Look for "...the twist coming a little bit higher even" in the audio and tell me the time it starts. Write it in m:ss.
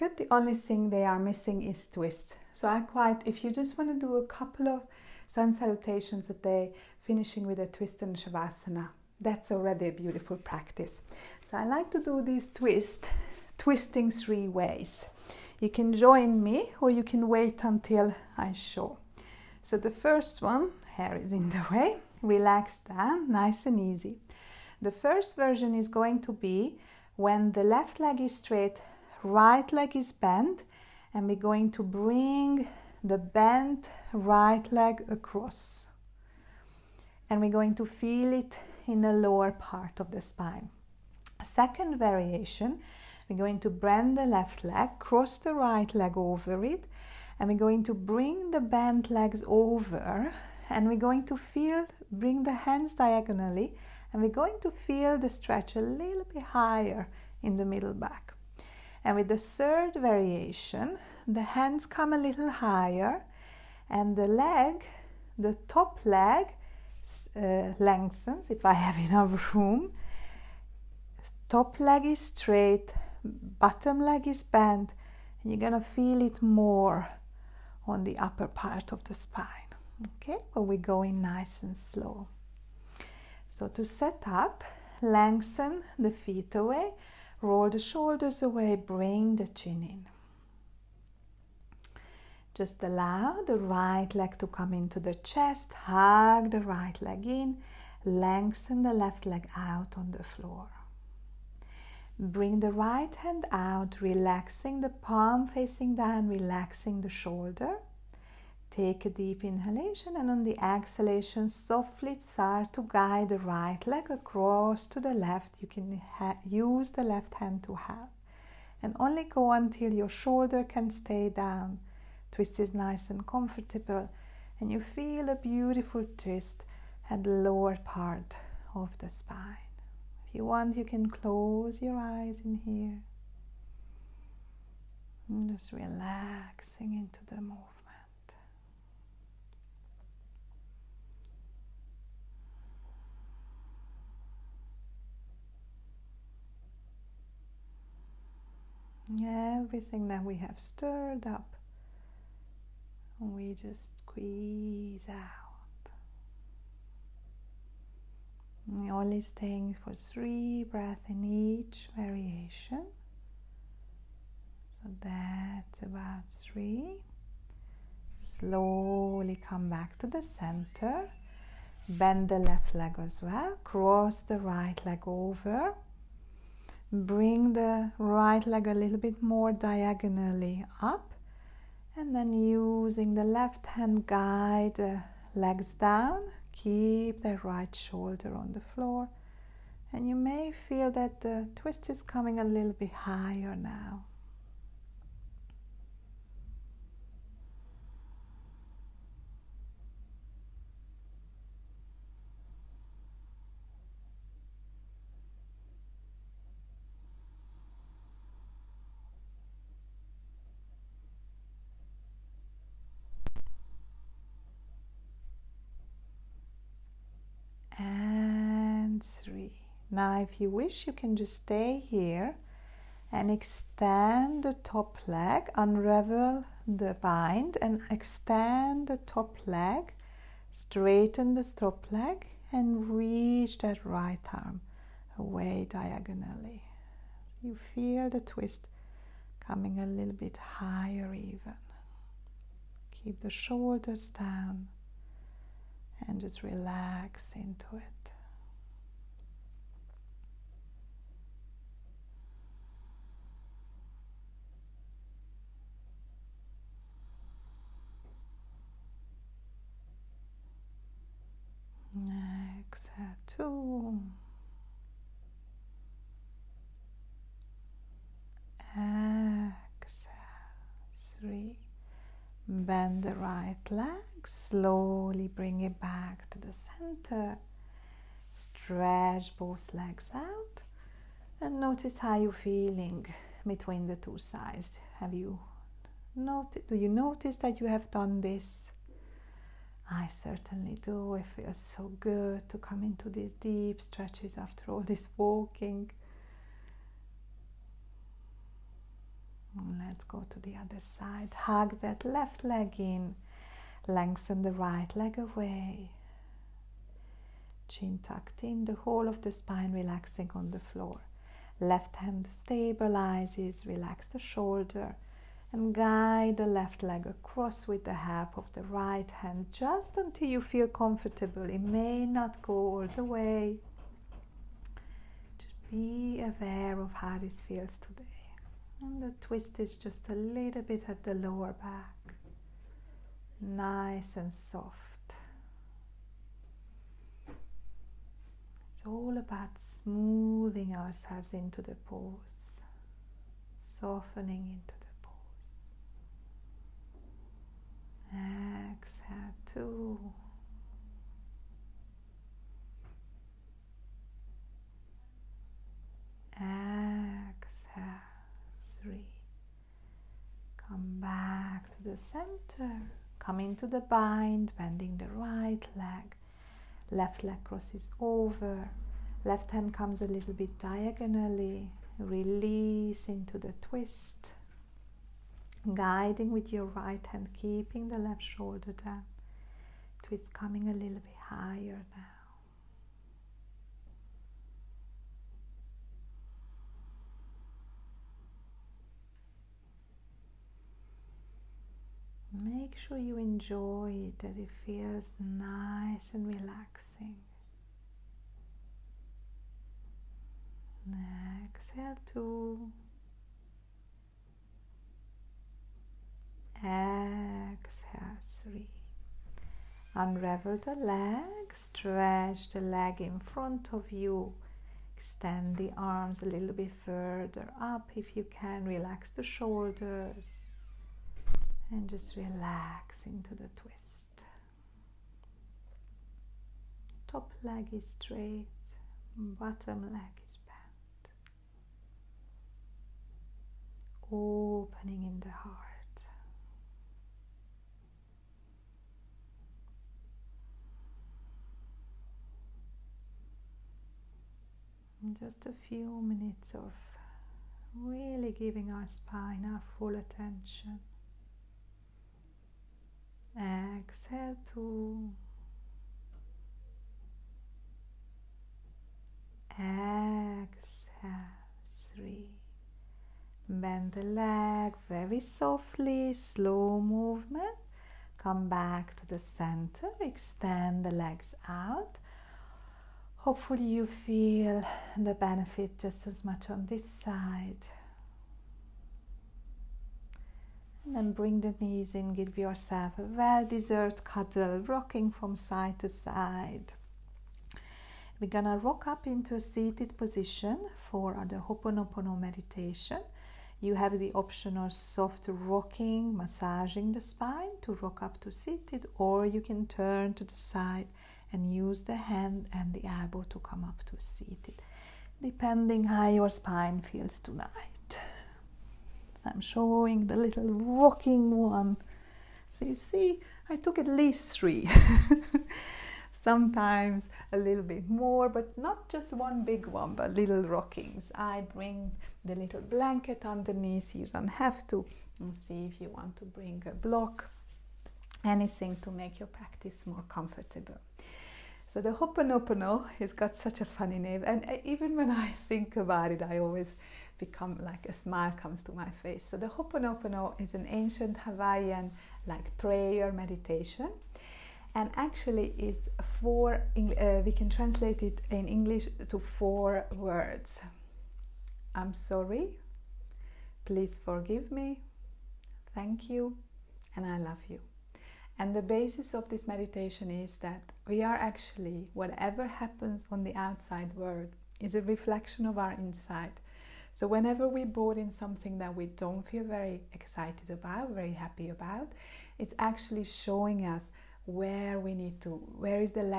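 3:58.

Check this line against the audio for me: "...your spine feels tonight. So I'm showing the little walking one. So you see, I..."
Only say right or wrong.
right.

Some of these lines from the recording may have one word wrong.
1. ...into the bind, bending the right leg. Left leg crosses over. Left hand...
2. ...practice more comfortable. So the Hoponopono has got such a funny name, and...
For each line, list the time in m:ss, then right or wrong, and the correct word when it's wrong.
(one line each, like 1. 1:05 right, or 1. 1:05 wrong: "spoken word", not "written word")
1. 6:03 right
2. 8:49 right.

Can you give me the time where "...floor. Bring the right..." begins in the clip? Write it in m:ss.
1:40.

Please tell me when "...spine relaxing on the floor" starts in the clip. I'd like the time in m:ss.
5:09.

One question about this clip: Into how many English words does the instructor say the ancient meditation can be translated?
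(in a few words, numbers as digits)
4.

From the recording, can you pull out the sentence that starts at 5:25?
Just be aware of how this feels today.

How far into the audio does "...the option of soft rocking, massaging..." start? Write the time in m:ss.
8:13.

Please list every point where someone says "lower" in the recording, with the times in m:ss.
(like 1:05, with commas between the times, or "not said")
0:39, 2:07, 5:31.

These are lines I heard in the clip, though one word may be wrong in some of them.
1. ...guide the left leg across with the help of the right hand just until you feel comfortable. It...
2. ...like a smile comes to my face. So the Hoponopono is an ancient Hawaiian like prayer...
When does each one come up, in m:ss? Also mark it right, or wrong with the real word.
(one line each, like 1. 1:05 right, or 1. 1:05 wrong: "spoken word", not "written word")
1. 5:15 right
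2. 8:57 right.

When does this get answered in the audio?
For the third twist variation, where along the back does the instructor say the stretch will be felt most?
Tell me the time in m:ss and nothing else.
1:18.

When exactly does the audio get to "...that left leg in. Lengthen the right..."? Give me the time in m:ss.
5:01.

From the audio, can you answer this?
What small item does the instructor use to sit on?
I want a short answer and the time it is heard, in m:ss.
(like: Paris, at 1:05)
little blanket, at 8:42.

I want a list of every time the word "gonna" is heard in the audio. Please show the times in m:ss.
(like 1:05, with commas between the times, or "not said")
1:15, 8:08.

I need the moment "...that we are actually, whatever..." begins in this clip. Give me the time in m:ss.
9:20.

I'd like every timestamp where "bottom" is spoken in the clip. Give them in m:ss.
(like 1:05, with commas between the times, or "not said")
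1:13, 7:09.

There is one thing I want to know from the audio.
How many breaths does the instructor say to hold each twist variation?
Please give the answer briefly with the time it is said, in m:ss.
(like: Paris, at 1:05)
3, at 2:39.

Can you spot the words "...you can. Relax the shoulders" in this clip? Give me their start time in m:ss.
6:58.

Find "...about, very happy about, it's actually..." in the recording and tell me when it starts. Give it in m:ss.
9:30.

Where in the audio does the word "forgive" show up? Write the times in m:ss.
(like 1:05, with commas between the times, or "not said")
9:14.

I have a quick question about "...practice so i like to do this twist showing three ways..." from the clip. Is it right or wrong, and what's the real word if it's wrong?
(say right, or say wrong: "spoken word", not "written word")
wrong: "twisting", not "showing".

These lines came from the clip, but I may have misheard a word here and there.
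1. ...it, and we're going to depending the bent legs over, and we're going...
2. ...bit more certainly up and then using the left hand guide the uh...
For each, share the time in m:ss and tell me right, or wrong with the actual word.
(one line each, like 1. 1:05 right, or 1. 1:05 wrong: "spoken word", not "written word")
1. 0:46 wrong: "bring", not "depending"
2. 2:58 wrong: "diagonally", not "certainly".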